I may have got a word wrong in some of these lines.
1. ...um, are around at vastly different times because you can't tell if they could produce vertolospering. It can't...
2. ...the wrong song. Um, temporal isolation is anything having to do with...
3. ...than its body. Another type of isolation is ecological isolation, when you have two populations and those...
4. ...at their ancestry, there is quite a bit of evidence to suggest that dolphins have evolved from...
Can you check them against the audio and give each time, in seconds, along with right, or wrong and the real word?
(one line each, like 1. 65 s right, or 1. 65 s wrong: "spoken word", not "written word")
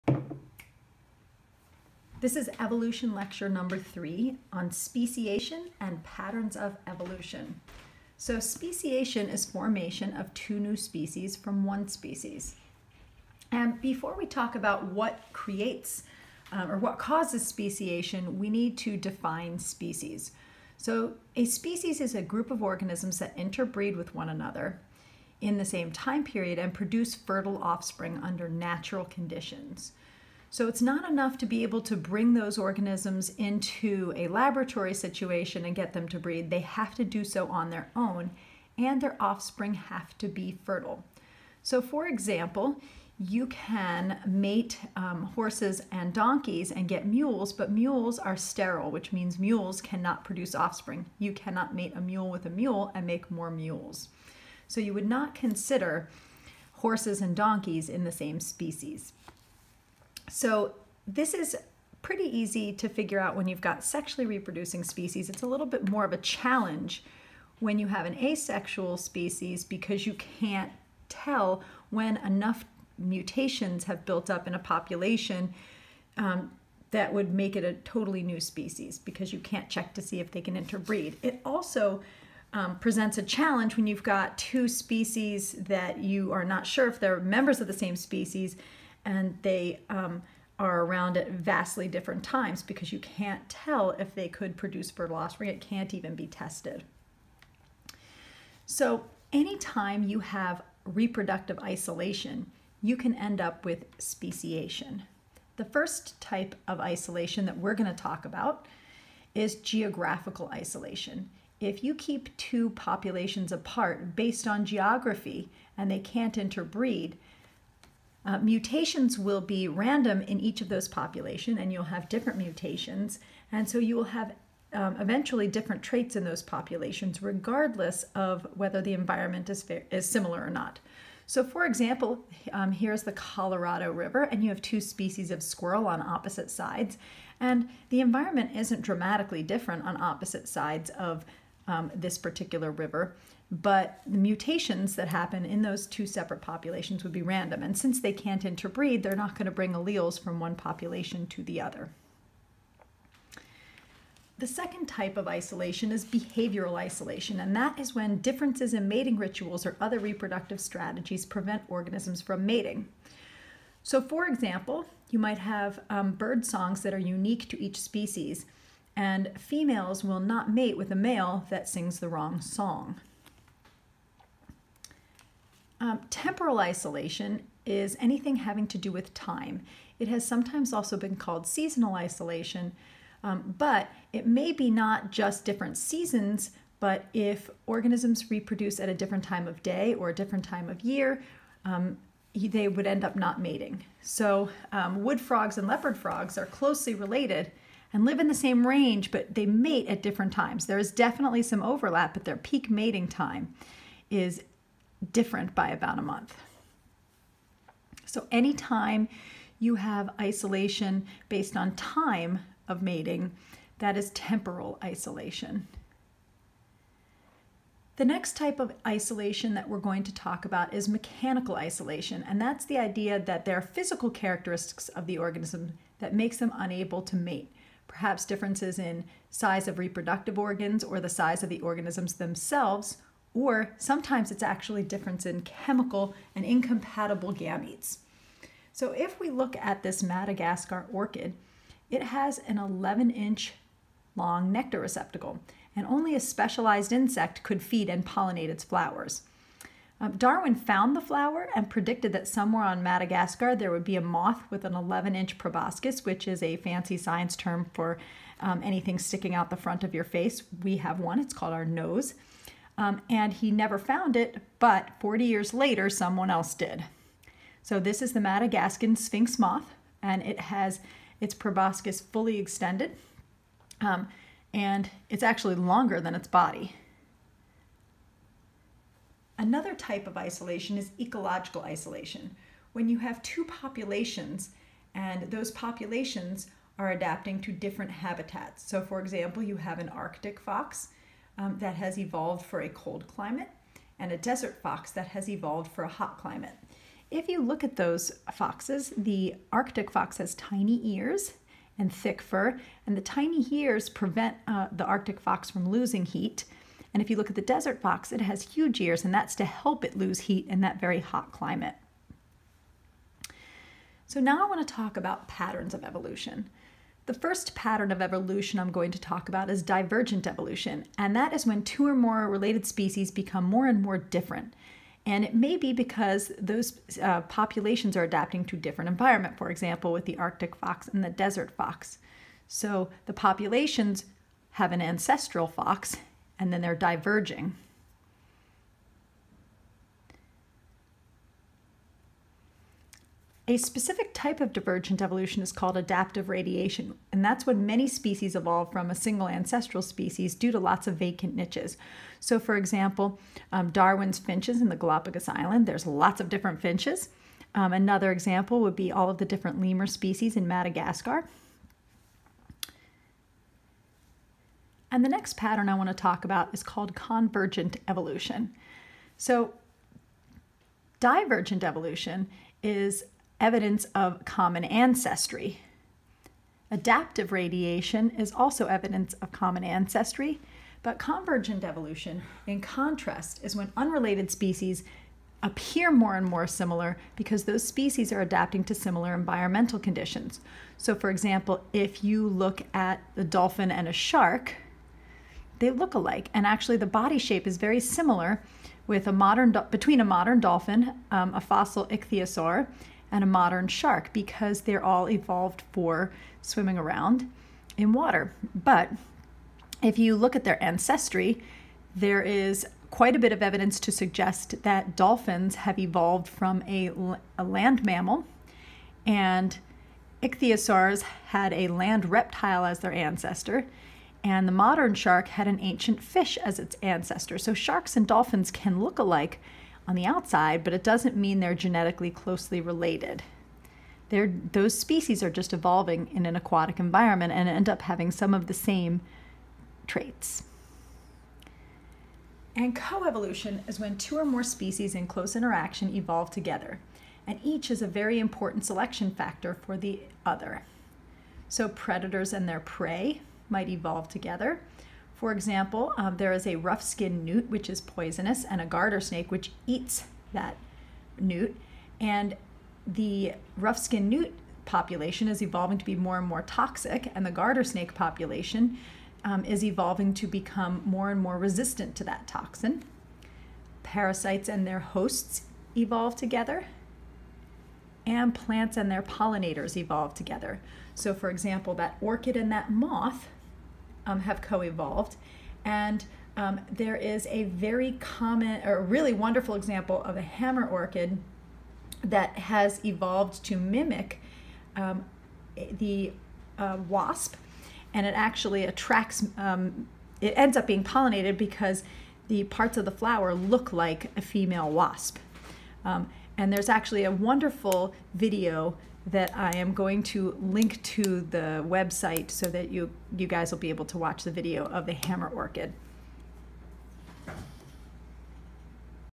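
1. 89 s right
2. 171 s right
3. 276 s right
4. 410 s right.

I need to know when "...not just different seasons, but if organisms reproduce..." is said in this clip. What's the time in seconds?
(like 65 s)
184 s.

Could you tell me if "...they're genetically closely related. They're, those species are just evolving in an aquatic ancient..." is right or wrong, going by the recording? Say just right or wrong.
wrong.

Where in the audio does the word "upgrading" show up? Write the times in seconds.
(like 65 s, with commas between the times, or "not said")
not said.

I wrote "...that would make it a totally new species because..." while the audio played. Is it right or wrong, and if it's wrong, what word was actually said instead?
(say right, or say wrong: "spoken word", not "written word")
right.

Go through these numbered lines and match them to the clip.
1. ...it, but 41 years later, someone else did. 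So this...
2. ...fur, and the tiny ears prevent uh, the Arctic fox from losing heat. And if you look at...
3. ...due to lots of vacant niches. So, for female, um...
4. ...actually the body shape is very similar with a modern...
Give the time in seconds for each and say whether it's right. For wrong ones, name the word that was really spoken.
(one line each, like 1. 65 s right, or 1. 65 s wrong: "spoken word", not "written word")
1. 264 s wrong: "40", not "41"
2. 302 s right
3. 350 s wrong: "example", not "female"
4. 396 s right.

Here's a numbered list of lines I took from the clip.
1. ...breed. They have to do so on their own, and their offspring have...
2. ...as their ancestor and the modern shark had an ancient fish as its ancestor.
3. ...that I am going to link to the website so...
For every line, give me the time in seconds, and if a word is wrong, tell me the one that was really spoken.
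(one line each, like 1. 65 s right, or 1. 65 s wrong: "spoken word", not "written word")
1. 36 s right
2. 422 s right
3. 509 s right.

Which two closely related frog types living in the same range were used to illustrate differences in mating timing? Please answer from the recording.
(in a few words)
Wood frogs and leopard frogs.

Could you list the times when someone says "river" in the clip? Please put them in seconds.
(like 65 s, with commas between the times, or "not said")
133 s, 142 s.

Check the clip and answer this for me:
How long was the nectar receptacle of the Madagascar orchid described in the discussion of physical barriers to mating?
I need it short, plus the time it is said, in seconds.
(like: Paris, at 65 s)
11 inches, at 242 s.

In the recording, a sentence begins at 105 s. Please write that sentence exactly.
The first type of isolation that we're going to talk about is geographical isolation.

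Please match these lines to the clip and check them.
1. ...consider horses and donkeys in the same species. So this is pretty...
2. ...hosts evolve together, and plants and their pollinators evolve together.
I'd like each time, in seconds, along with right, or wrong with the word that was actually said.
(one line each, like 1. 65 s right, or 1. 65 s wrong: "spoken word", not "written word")
1. 55 s right
2. 474 s right.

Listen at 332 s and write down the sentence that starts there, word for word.
So the populations have an ancestral fox and then they're diverging.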